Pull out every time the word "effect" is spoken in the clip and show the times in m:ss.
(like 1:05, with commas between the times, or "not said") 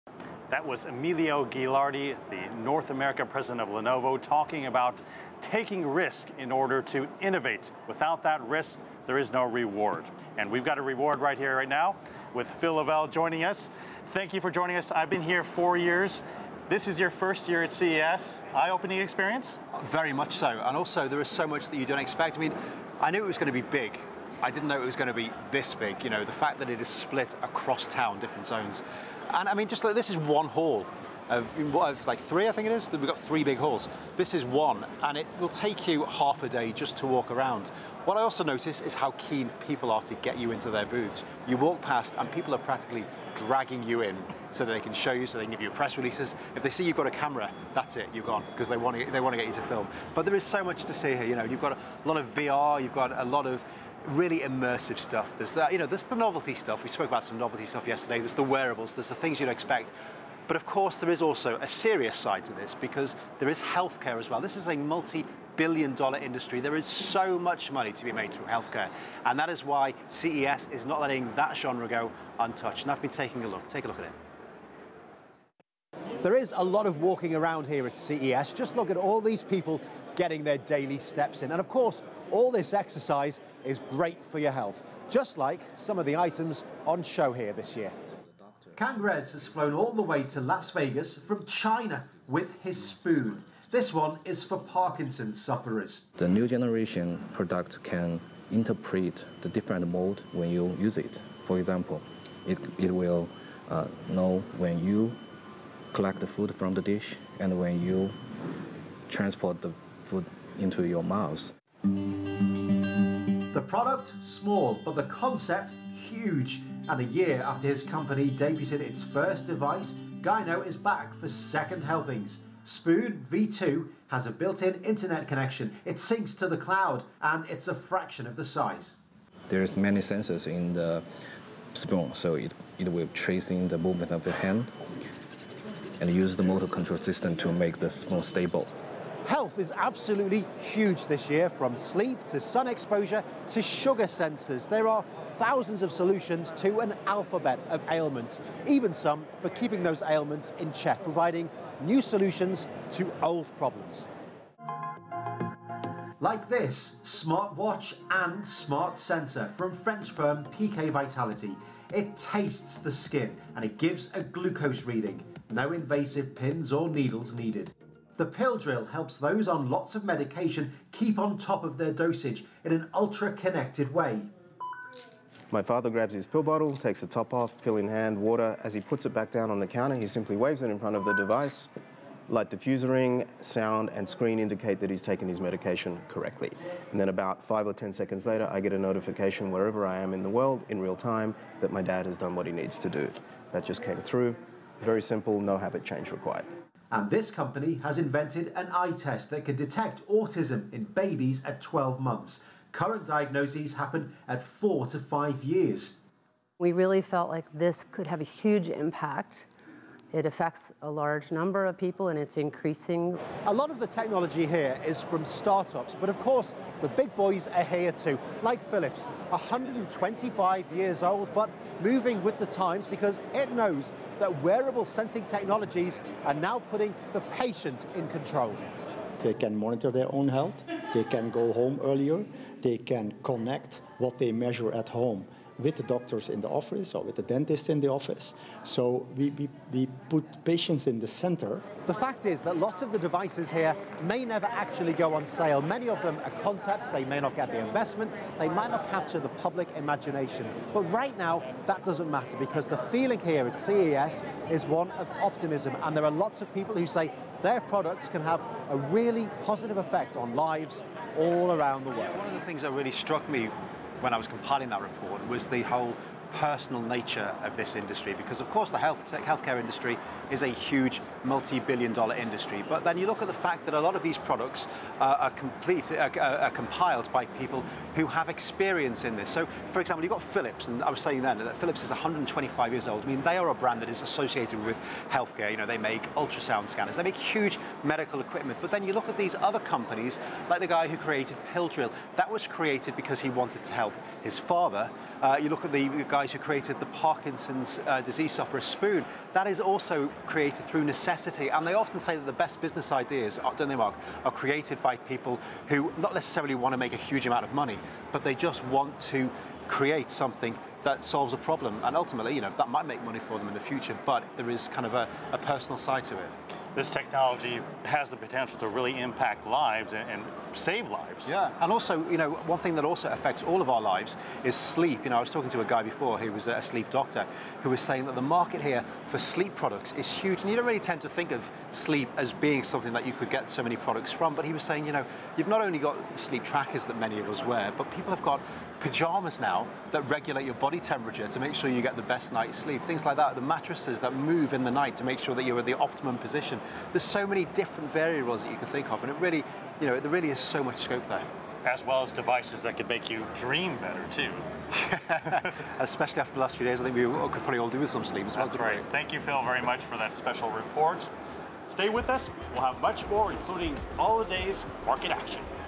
4:19.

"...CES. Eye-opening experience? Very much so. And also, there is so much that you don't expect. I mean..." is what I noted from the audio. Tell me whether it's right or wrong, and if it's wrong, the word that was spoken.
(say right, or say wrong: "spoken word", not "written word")
right.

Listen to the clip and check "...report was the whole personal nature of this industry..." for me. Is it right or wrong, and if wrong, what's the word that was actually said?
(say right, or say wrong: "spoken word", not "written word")
right.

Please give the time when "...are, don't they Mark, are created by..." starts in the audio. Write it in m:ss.
5:03.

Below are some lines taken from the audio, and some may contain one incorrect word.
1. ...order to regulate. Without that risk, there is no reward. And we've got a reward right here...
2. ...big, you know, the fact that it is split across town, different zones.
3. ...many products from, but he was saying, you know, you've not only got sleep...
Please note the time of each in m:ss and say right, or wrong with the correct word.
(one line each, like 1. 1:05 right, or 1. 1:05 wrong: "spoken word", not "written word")
1. 0:06 wrong: "innovate", not "regulate"
2. 0:25 right
3. 5:33 right.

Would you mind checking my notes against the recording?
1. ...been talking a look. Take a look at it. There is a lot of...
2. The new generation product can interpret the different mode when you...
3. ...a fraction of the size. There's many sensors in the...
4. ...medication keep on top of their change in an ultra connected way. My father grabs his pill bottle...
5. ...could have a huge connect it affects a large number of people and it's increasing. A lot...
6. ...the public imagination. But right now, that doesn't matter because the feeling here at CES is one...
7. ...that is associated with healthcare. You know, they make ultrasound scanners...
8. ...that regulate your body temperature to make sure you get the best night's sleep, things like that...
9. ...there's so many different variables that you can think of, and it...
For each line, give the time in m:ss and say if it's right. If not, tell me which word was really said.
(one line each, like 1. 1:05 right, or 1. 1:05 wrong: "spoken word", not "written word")
1. 1:13 wrong: "taking", not "talking"
2. 1:36 right
3. 2:07 right
4. 2:50 wrong: "dosage", not "change"
5. 3:27 wrong: "impact", not "connect"
6. 4:09 right
7. 4:43 right
8. 5:39 right
9. 5:46 right.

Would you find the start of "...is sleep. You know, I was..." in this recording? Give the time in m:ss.
5:24.